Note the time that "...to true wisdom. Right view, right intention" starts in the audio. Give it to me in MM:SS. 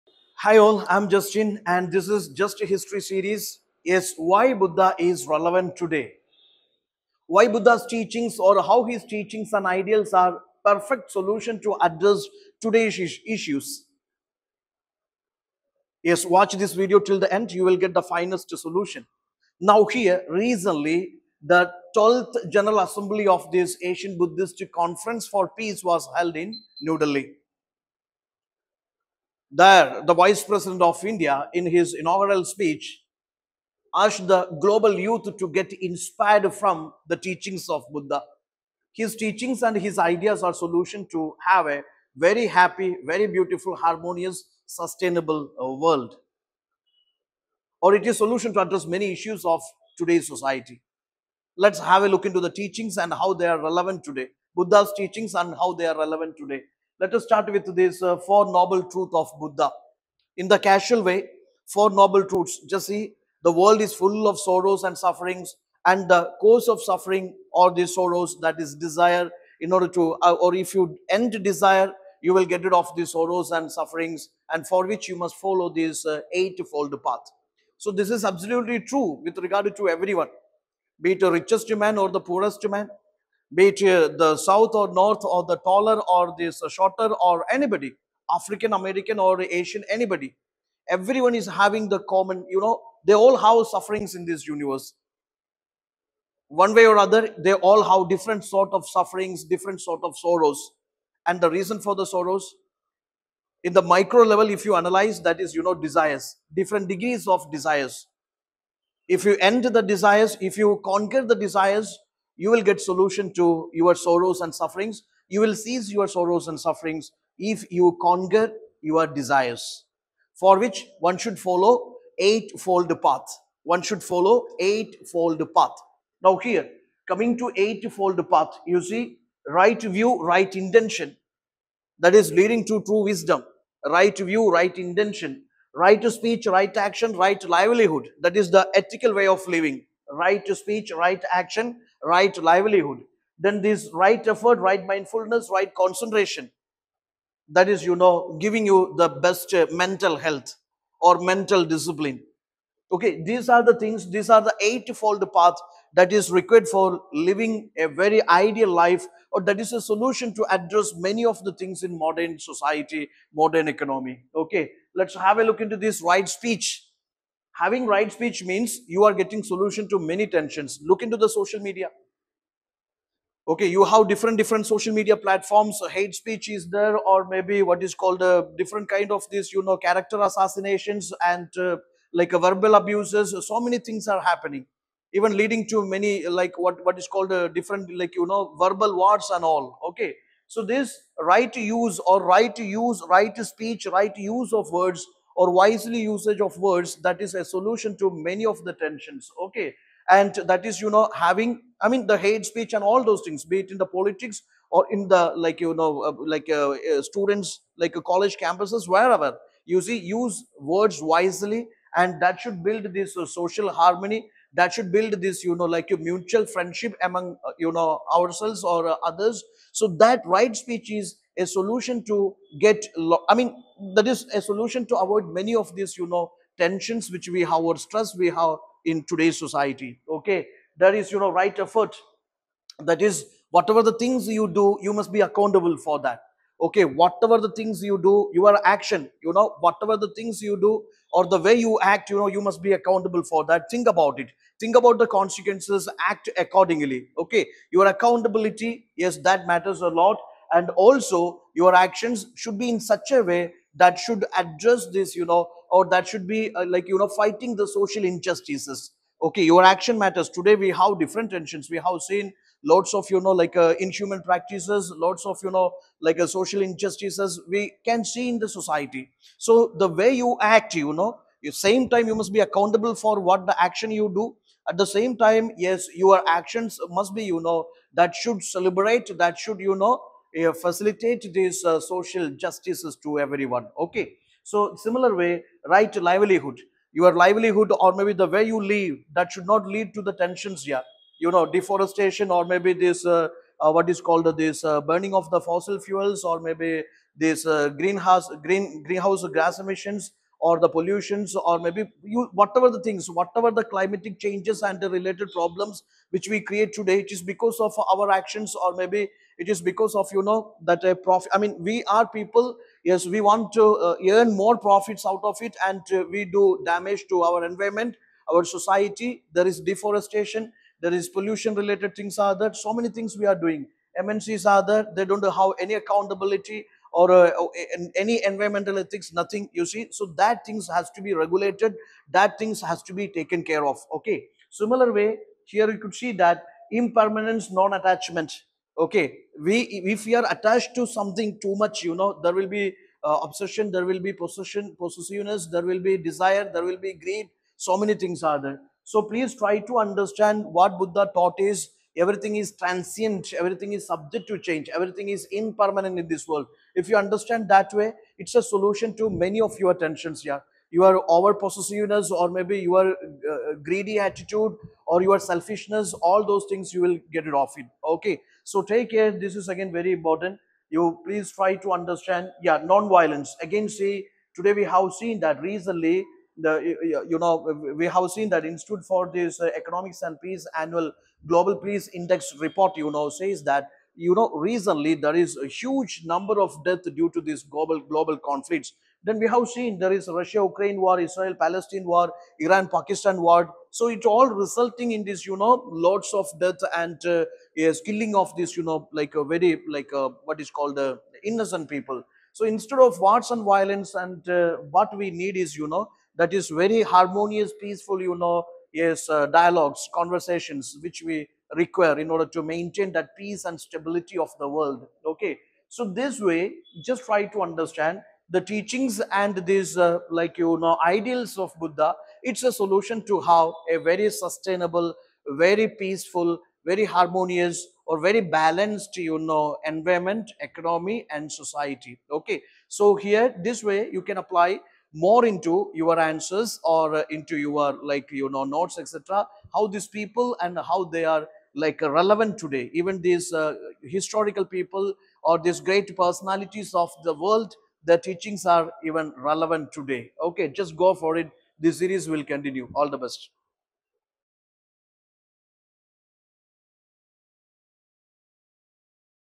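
02:12.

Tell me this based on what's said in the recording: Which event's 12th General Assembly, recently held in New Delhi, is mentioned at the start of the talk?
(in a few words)
Asian Buddhist Conference for Peace.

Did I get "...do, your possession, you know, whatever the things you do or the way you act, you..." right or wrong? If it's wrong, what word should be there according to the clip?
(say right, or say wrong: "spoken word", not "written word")
wrong: "action", not "possession".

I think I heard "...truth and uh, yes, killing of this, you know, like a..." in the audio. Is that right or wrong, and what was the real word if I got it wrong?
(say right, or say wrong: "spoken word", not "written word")
wrong: "death", not "truth".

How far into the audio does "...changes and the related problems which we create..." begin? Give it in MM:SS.
05:04.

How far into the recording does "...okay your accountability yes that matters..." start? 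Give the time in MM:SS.
04:07.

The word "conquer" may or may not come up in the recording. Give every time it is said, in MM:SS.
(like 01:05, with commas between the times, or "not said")
01:50, 01:58.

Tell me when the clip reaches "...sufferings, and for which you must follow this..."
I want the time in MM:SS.
01:13.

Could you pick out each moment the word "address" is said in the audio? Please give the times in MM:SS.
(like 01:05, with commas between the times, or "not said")
00:11, 00:48, 02:40, 04:14.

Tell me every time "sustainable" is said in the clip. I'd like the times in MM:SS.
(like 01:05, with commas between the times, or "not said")
00:44, 07:04.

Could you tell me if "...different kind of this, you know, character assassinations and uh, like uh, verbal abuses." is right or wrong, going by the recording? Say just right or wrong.
right.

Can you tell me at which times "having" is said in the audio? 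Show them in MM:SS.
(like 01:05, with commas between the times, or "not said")
01:31, 02:47, 03:21.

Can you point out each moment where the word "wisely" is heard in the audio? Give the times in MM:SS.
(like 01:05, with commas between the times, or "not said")
03:15, 03:31.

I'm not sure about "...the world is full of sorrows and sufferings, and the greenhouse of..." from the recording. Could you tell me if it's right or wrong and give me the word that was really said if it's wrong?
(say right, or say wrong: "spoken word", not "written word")
wrong: "cause", not "greenhouse".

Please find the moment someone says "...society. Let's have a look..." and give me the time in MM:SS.
00:50.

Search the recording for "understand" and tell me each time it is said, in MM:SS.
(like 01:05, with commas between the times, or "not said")
05:49, 05:56, 06:11, 06:57.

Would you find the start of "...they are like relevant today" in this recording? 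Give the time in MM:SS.
07:20.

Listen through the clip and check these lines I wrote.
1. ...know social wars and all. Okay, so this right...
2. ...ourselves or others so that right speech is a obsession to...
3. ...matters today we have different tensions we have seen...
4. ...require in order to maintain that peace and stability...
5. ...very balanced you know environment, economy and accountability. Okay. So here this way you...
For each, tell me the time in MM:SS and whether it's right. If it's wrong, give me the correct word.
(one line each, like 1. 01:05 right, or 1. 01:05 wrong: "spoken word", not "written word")
1. 03:08 wrong: "verbal", not "social"
2. 03:38 wrong: "solution", not "obsession"
3. 04:19 right
4. 06:51 right
5. 07:08 wrong: "society", not "accountability".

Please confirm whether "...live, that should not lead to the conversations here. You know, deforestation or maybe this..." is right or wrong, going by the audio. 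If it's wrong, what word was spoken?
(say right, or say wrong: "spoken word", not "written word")
wrong: "tensions", not "conversations".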